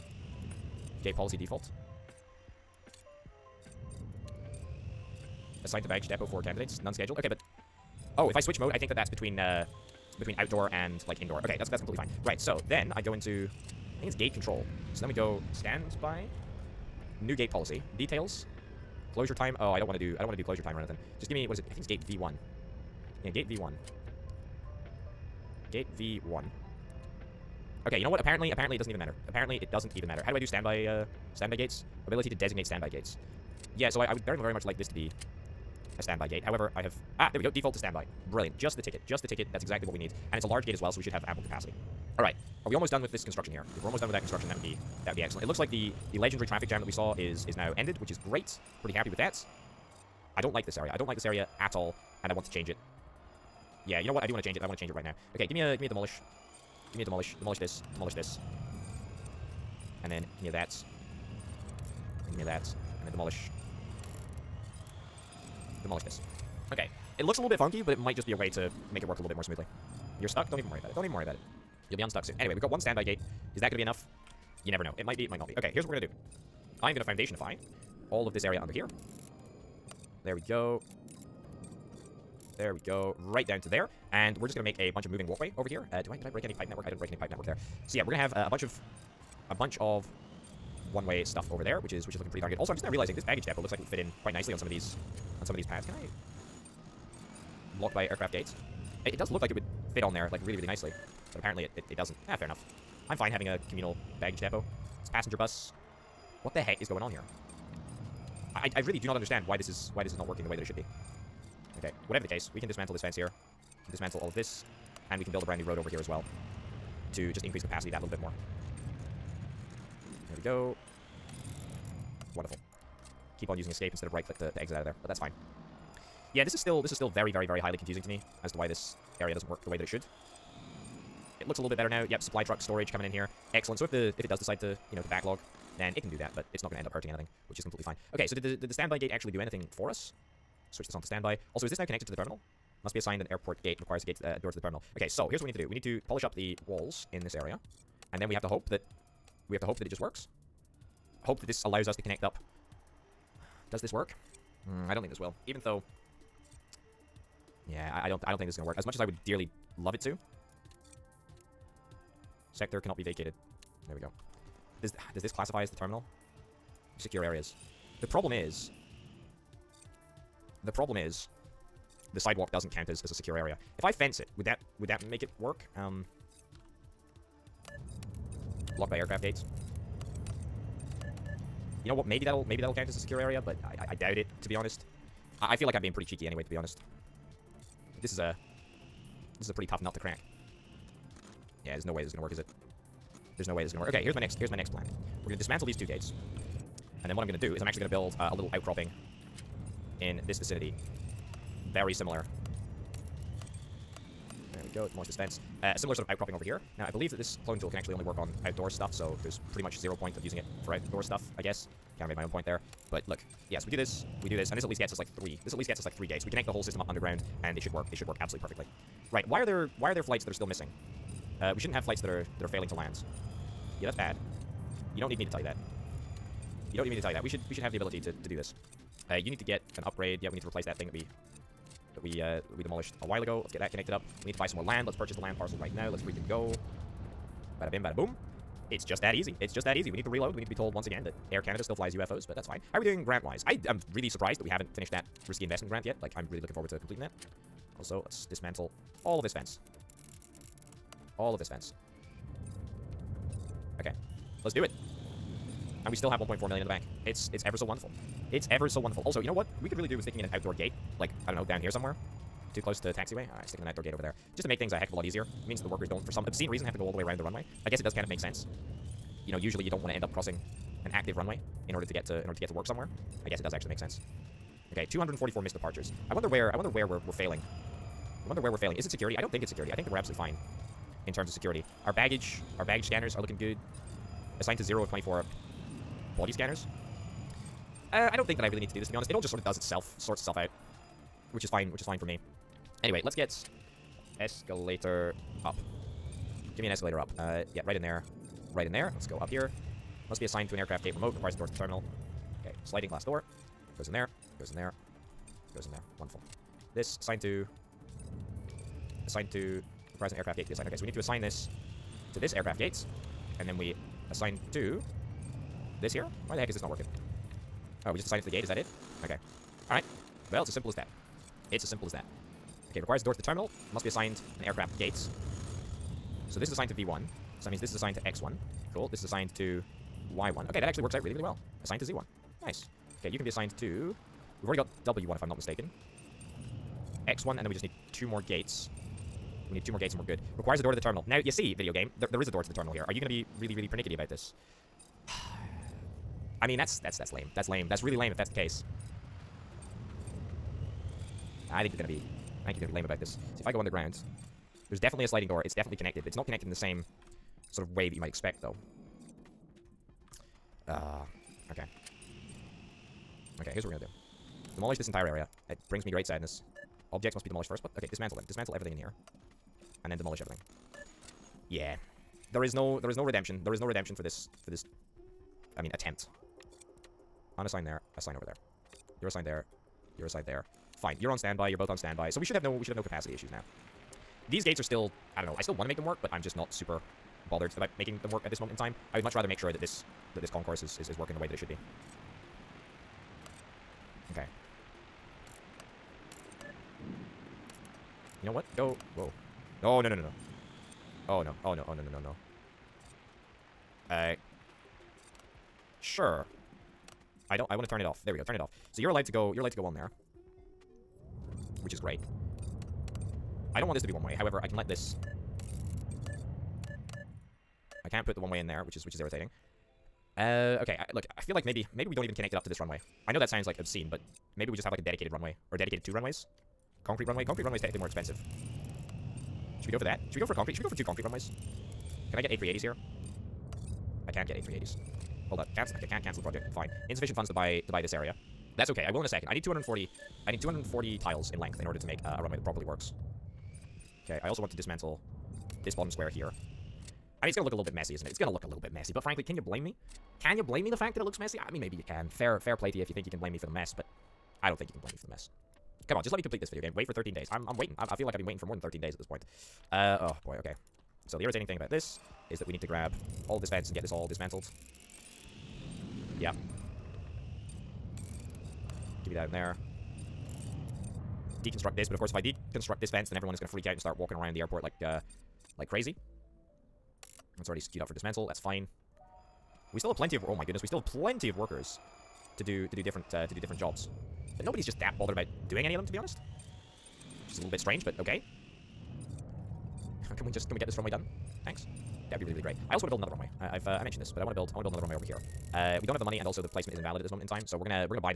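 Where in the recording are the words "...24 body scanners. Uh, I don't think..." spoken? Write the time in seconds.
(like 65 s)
284 s.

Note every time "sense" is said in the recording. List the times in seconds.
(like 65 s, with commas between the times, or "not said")
268 s, 273 s.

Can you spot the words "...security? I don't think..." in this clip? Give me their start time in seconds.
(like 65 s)
278 s.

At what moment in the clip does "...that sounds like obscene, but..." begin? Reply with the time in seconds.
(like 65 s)
423 s.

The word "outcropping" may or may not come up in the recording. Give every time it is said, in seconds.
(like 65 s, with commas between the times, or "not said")
198 s, 206 s.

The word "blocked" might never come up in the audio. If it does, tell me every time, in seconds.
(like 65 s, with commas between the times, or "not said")
97 s, 178 s.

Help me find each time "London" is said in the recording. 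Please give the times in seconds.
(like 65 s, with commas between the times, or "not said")
not said.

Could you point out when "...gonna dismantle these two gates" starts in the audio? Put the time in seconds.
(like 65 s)
195 s.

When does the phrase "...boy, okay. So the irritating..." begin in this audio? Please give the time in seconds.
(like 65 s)
460 s.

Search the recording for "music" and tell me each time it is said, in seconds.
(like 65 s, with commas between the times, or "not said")
not said.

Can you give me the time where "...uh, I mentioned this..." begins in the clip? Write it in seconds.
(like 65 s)
493 s.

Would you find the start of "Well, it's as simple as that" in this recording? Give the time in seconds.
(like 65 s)
320 s.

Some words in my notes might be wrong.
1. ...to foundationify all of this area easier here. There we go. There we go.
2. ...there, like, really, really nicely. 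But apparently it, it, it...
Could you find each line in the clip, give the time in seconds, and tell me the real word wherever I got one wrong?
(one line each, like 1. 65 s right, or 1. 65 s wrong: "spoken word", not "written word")
1. 76 s wrong: "under", not "easier"
2. 100 s right.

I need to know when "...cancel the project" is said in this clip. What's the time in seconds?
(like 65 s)
436 s.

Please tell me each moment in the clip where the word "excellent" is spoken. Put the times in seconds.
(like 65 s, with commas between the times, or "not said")
45 s, 133 s.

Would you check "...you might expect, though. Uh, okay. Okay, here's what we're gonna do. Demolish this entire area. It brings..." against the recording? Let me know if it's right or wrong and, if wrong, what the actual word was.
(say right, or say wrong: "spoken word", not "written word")
right.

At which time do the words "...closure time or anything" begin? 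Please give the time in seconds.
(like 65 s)
20 s.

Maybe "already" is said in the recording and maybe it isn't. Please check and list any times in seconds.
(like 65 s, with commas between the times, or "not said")
334 s, 477 s.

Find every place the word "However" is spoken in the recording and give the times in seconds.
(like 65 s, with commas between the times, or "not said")
36 s, 414 s.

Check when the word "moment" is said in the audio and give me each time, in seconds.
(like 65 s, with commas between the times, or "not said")
388 s, 497 s.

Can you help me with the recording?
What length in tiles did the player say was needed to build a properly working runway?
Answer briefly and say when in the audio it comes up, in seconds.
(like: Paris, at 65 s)
240 tiles, at 440 s.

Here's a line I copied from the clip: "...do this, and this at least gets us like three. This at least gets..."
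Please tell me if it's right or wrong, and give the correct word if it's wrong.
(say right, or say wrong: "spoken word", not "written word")
right.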